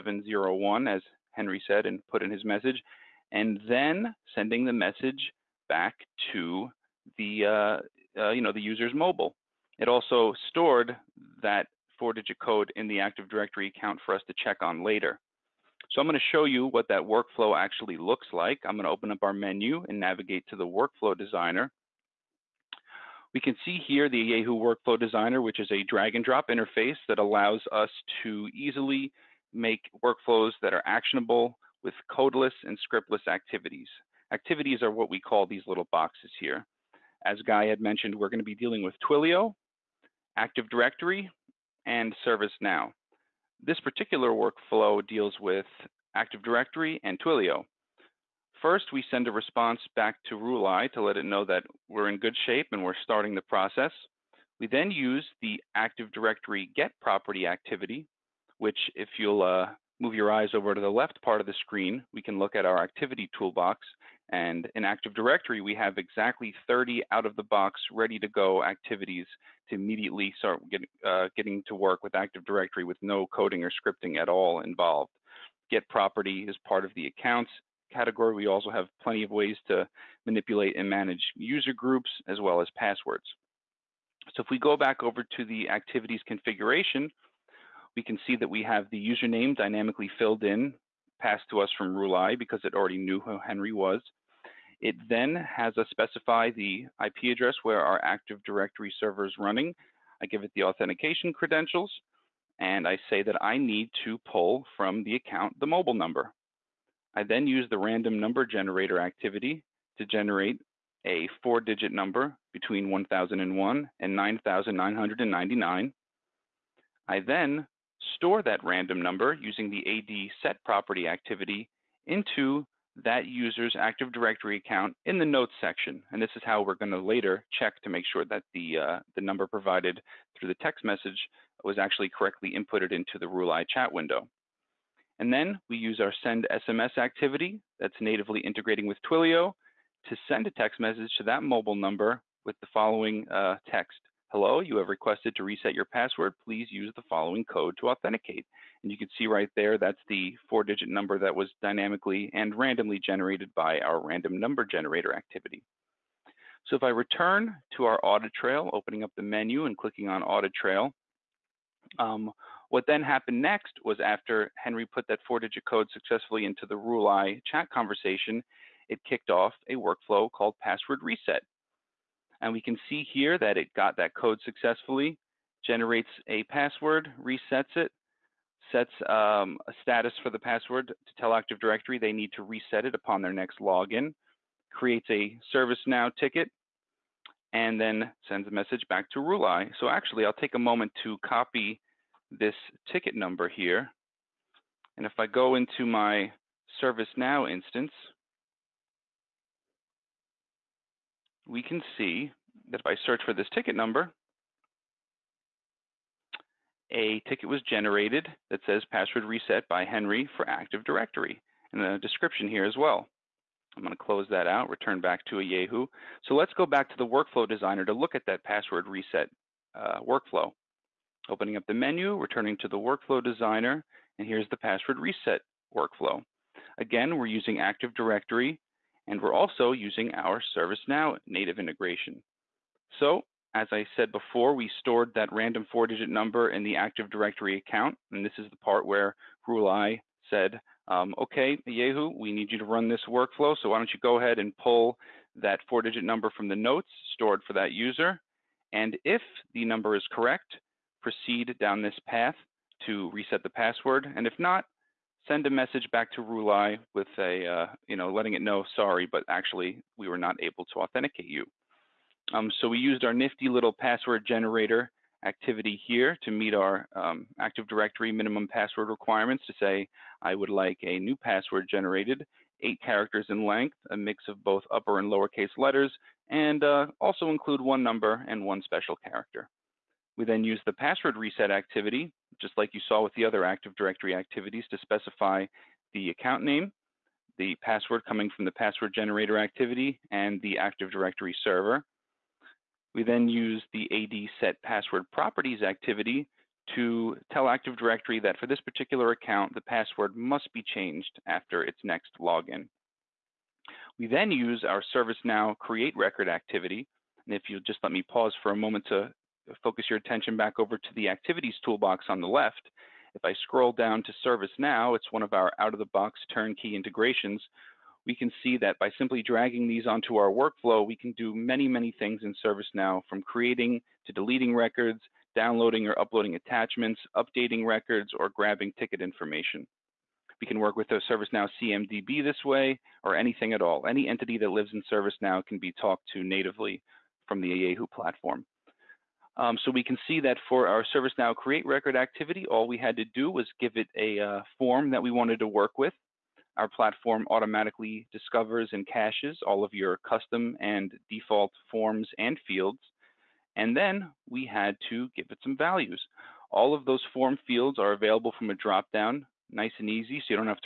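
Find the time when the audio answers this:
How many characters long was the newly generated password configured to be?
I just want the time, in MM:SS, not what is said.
04:32.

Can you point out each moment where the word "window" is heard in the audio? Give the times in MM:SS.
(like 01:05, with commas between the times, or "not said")
02:13.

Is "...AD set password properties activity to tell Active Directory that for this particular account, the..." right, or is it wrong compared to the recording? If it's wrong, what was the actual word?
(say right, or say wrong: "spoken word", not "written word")
right.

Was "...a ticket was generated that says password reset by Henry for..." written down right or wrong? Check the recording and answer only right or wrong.
right.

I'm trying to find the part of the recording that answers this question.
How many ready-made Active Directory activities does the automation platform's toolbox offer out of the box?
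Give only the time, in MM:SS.
01:05.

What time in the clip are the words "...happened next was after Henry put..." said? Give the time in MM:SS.
02:43.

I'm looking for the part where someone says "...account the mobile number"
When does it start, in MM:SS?
01:45.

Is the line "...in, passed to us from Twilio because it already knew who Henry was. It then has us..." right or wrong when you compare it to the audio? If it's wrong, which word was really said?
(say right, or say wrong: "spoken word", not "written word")
wrong: "Rulai", not "Twilio".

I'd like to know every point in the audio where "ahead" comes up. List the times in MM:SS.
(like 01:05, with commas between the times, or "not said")
04:04.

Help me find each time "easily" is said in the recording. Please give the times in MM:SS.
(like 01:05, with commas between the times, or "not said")
00:28.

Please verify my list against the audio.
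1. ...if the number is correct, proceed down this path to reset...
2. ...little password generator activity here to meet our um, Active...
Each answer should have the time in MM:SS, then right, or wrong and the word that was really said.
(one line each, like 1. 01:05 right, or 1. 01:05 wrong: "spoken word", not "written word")
1. 04:09 right
2. 04:23 right.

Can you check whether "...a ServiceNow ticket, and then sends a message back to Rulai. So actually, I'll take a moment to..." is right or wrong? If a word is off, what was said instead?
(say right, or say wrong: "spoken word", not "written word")
right.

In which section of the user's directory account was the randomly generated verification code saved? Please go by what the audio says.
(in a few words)
notes section.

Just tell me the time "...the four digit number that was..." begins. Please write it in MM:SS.
02:30.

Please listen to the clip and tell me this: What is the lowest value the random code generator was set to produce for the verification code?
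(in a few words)
1001.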